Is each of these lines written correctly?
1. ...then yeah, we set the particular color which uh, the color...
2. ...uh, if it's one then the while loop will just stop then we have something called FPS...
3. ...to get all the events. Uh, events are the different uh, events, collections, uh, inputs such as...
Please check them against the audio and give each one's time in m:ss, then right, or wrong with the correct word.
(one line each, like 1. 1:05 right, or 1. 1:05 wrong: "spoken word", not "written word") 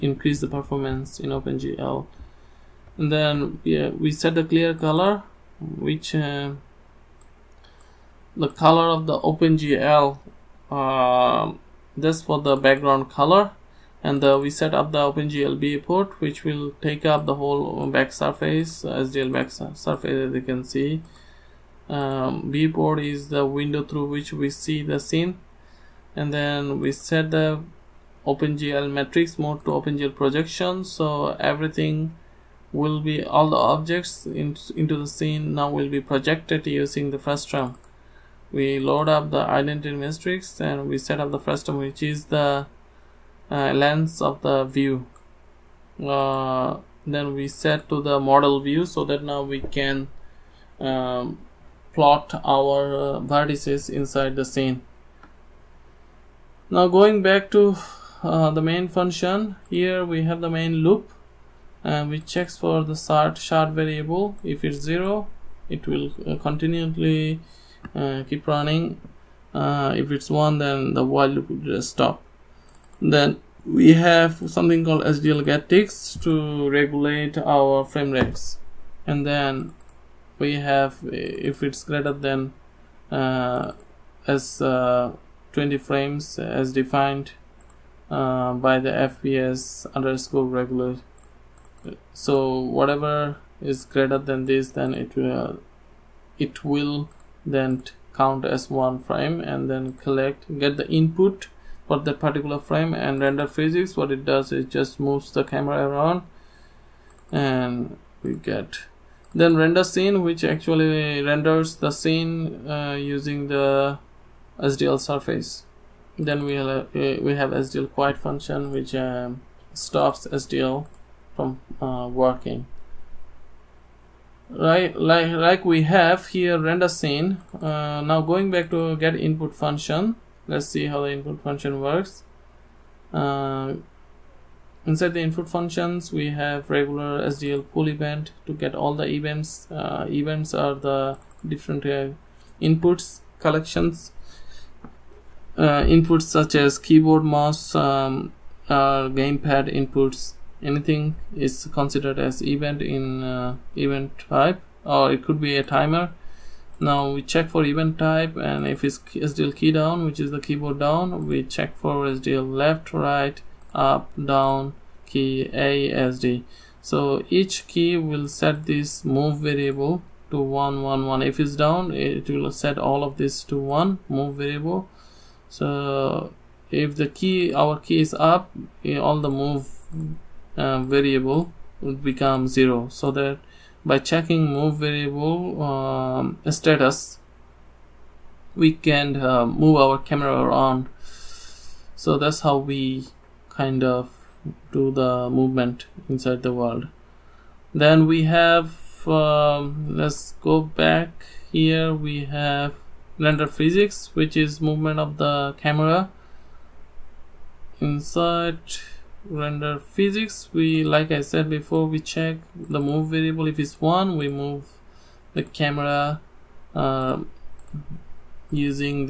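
1. 0:03 wrong: "clear", not "particular"
2. 1:09 wrong: "SDL", not "FPS"
3. 2:18 wrong: "inputs", not "events".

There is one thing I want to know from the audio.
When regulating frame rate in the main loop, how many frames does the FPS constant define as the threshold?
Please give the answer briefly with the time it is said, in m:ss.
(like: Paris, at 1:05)
20, at 1:25.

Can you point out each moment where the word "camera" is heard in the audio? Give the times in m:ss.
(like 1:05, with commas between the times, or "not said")
1:45, 3:09, 3:25, 3:35.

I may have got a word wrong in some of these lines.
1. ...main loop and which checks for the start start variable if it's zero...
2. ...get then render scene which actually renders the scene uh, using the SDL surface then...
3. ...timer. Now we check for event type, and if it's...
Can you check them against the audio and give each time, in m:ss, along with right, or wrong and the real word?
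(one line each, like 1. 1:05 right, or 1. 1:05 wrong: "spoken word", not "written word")
1. 1:00 right
2. 1:48 right
3. 2:35 right.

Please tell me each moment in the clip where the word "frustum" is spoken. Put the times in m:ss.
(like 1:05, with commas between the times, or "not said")
0:37, 0:41.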